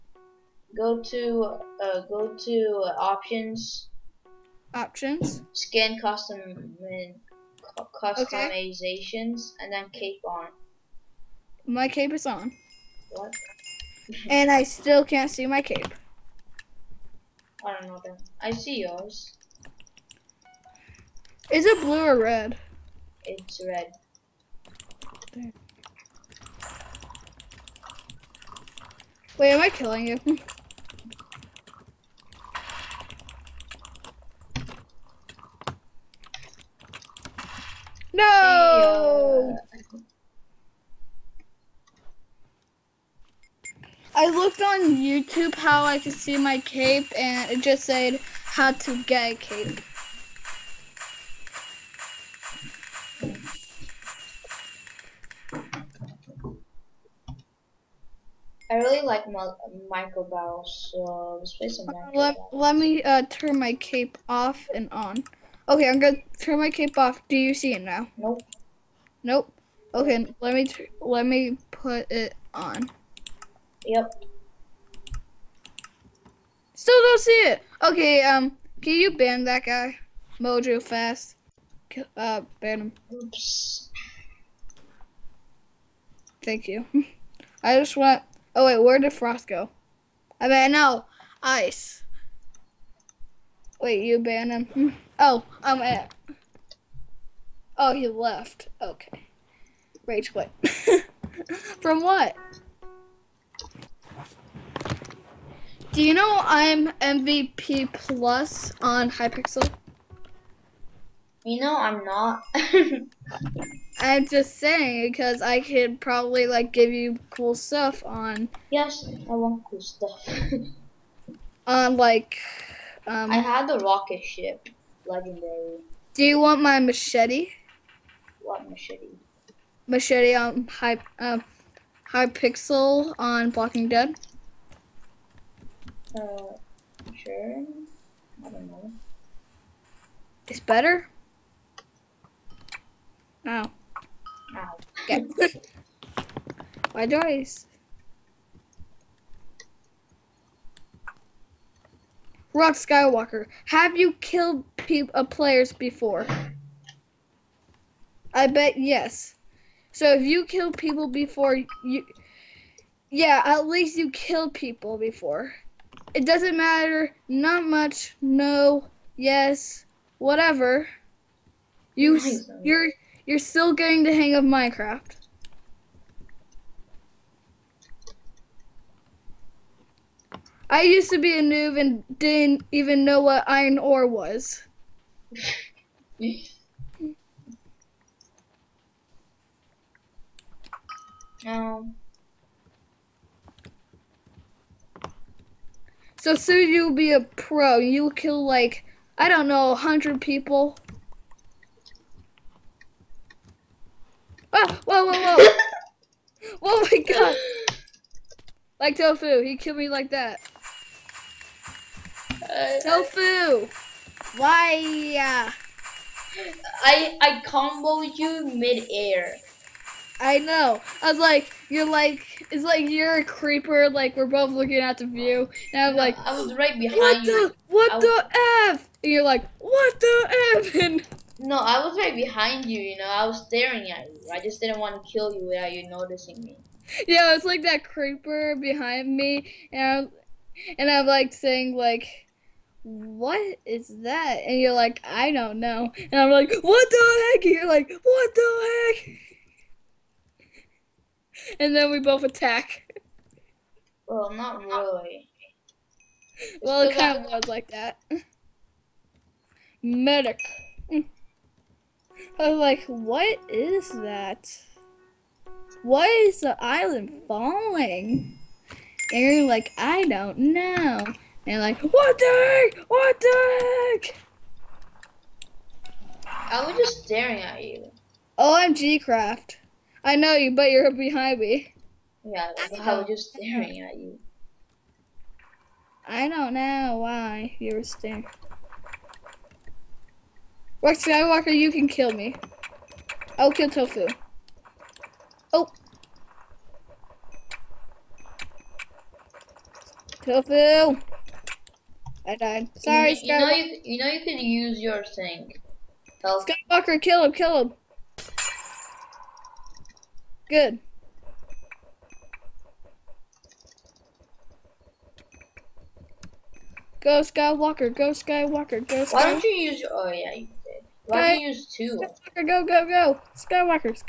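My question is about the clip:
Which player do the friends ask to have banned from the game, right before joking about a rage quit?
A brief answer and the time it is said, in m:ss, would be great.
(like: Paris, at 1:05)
Mojo Fast, at 1:20.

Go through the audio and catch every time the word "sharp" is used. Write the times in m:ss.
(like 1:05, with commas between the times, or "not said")
not said.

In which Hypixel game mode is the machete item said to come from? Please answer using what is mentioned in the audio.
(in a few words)
Blocking Dead.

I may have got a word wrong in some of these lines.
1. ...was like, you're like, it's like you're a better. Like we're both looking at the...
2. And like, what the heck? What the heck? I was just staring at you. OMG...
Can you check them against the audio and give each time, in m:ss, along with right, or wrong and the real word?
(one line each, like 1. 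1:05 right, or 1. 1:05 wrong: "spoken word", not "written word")
1. 3:41 wrong: "creeper", not "better"
2. 4:31 right.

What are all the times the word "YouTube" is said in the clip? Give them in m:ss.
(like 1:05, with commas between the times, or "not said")
0:44.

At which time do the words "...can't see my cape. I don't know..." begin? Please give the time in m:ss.
0:15.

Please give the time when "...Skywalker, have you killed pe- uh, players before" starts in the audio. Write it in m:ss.
2:32.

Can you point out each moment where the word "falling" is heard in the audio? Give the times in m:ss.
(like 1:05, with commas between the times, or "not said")
4:27.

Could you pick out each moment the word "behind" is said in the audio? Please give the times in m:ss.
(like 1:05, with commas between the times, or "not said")
3:46, 3:52, 3:58, 4:40.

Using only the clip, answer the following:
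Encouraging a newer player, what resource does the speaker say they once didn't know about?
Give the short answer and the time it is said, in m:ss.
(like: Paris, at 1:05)
iron ore, at 3:03.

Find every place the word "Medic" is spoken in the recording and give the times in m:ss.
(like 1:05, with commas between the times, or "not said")
4:19.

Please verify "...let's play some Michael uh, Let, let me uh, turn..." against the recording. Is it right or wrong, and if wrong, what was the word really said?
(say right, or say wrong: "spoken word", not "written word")
right.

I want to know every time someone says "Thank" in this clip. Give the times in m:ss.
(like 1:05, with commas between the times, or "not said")
1:26.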